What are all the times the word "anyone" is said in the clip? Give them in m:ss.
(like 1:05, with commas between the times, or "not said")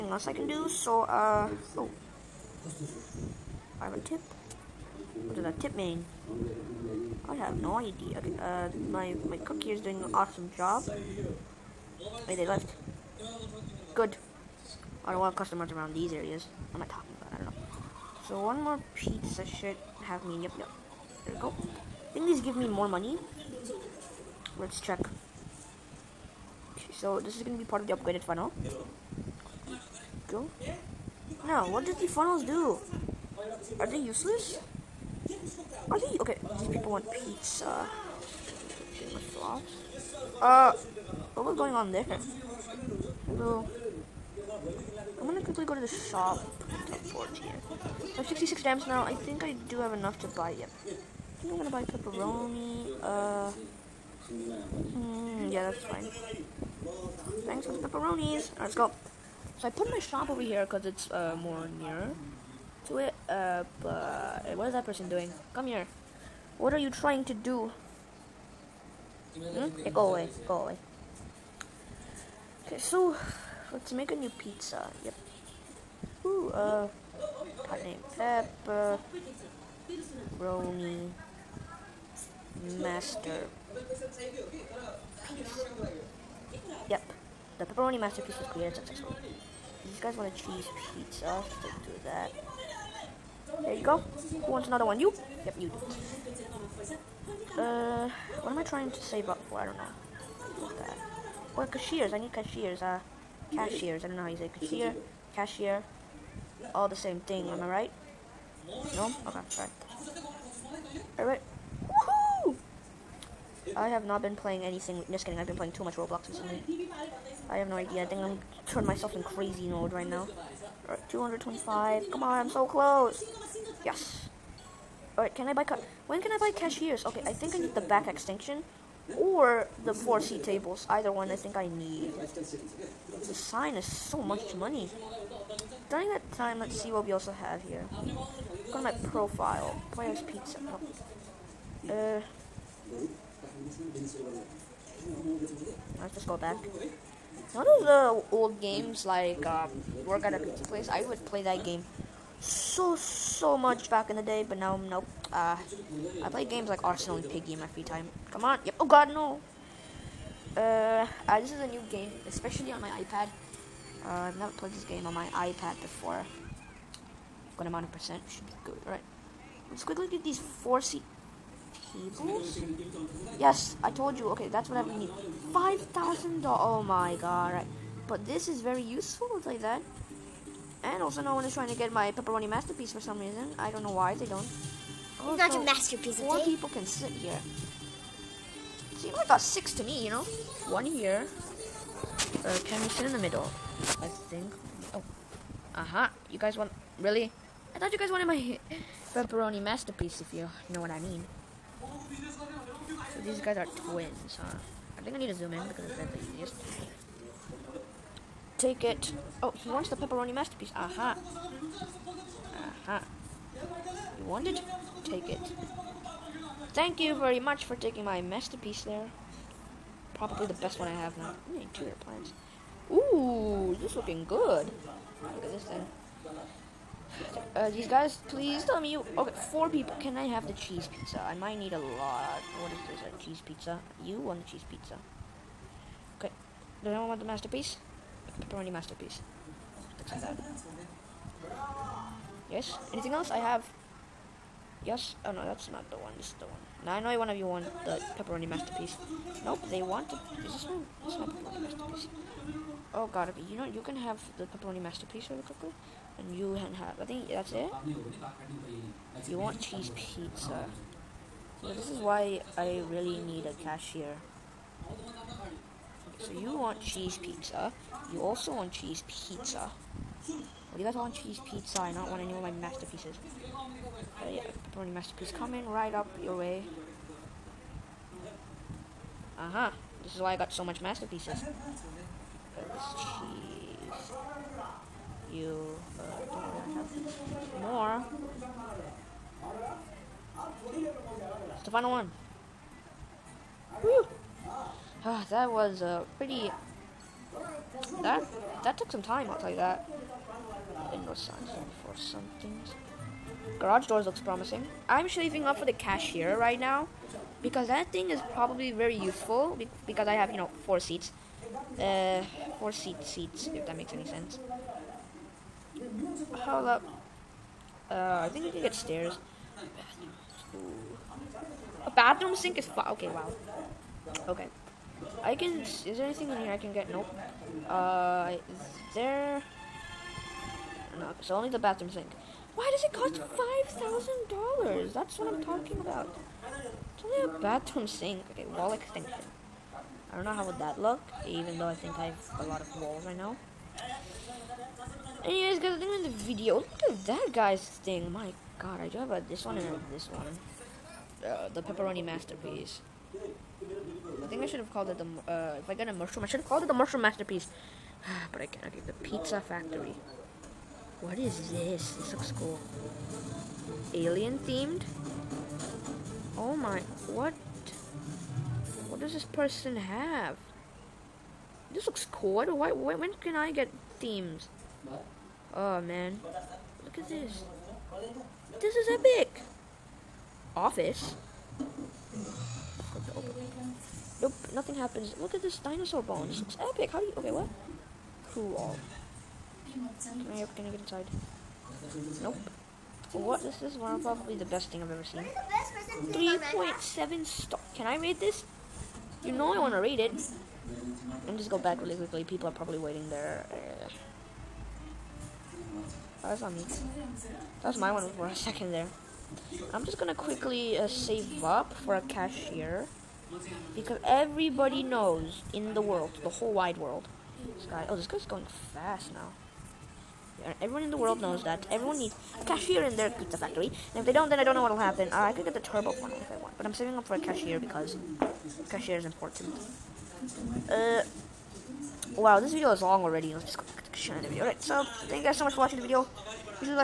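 3:56.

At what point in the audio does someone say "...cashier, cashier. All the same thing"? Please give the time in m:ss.
1:44.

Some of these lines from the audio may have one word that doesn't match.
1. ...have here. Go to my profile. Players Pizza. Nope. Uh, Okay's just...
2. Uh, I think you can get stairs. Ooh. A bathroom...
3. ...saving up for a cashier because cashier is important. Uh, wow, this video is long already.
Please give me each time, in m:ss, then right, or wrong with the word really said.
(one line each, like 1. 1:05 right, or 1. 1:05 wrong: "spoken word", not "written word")
1. 2:17 wrong: "Let", not "Okay"
2. 5:17 right
3. 7:06 right.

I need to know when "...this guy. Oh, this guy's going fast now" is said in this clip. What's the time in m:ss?
6:57.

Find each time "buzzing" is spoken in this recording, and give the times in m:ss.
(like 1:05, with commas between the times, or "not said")
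not said.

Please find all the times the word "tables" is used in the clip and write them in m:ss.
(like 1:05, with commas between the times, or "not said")
2:10, 2:51.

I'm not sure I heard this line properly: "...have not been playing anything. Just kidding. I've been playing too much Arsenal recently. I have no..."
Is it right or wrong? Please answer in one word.
wrong.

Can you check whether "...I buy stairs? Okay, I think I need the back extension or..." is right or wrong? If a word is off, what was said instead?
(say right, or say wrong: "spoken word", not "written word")
wrong: "cashiers", not "stairs".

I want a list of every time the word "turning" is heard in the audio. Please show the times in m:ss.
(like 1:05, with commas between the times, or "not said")
1:58.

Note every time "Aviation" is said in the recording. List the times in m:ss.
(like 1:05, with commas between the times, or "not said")
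not said.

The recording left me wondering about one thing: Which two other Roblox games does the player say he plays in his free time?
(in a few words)
Arsenal and Piggy.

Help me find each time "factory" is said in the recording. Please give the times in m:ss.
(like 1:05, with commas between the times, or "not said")
5:59, 7:03.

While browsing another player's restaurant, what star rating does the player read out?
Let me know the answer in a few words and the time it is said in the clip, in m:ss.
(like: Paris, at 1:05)
3.7, at 6:36.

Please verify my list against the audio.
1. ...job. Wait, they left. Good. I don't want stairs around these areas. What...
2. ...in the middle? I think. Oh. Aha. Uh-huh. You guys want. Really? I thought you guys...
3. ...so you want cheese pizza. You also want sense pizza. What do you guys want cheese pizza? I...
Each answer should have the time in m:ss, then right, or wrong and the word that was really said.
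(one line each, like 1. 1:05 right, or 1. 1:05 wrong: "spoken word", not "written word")
1. 0:10 wrong: "customers", not "stairs"
2. 3:13 right
3. 4:26 wrong: "cheese", not "sense".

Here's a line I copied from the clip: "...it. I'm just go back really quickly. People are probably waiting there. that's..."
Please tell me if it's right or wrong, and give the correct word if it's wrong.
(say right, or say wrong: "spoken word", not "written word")
right.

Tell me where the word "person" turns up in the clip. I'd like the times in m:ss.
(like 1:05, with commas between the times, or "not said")
1:04, 6:09.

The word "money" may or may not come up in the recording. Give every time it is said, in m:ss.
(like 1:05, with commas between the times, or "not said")
0:22, 2:14.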